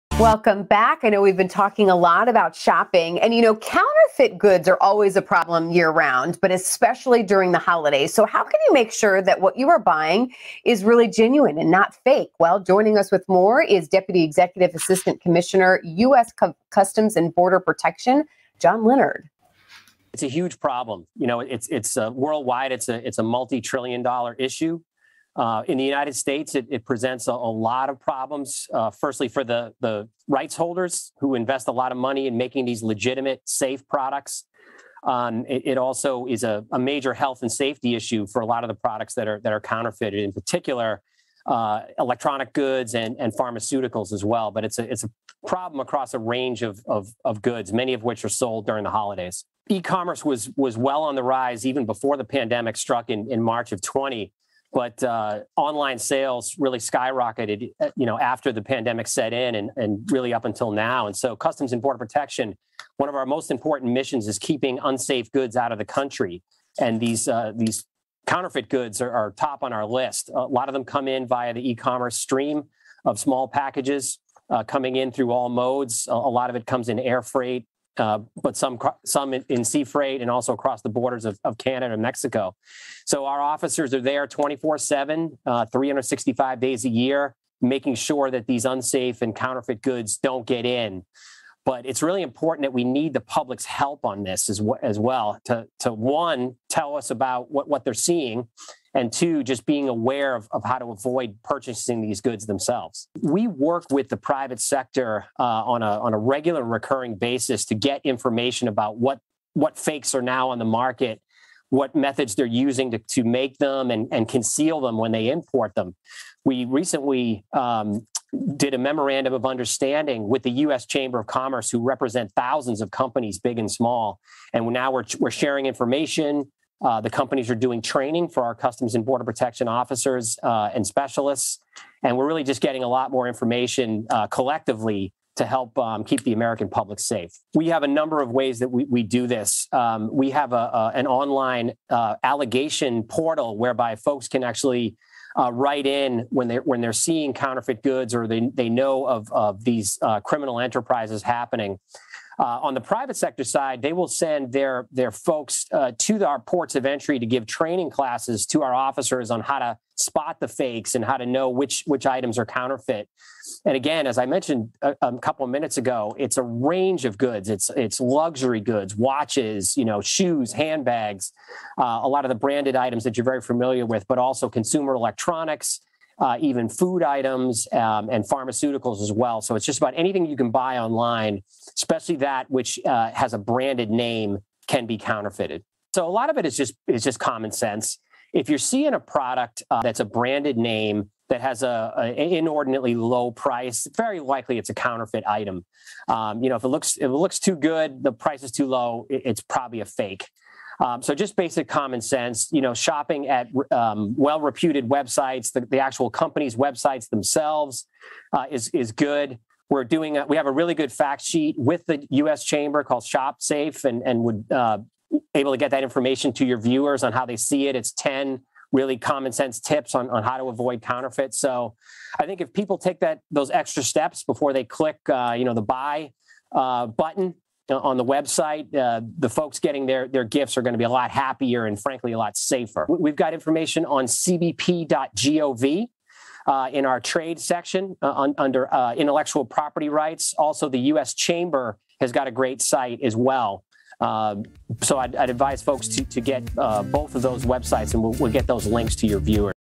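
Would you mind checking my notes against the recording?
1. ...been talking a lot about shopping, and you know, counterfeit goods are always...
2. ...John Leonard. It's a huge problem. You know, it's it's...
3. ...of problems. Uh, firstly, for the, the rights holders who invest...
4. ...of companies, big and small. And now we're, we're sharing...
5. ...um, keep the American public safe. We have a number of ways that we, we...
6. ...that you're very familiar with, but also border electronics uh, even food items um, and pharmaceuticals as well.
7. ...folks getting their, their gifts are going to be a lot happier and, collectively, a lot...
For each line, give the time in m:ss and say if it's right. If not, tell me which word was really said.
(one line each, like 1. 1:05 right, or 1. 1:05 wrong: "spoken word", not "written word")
1. 0:01 right
2. 0:18 right
3. 0:27 right
4. 2:02 right
5. 2:15 right
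6. 2:53 wrong: "consumer", not "border"
7. 3:49 wrong: "frankly", not "collectively".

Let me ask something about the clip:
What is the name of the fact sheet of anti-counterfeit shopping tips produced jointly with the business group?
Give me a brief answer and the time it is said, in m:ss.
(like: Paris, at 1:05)
Shop Safe, at 3:33.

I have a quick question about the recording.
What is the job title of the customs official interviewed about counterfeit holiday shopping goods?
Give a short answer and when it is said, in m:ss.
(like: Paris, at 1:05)
Deputy Executive Assistant Commissioner, at 0:13.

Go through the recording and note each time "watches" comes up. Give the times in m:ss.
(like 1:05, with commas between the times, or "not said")
2:48.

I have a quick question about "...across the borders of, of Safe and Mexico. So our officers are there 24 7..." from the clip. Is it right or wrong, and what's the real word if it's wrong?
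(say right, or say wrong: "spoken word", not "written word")
wrong: "Canada", not "Safe".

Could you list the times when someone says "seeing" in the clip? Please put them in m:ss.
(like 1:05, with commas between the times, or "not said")
1:37, 2:26, 3:08.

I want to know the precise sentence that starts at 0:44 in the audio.
But it's a it's a problem across a range of, of, of goods, many of which are sold during the holidays.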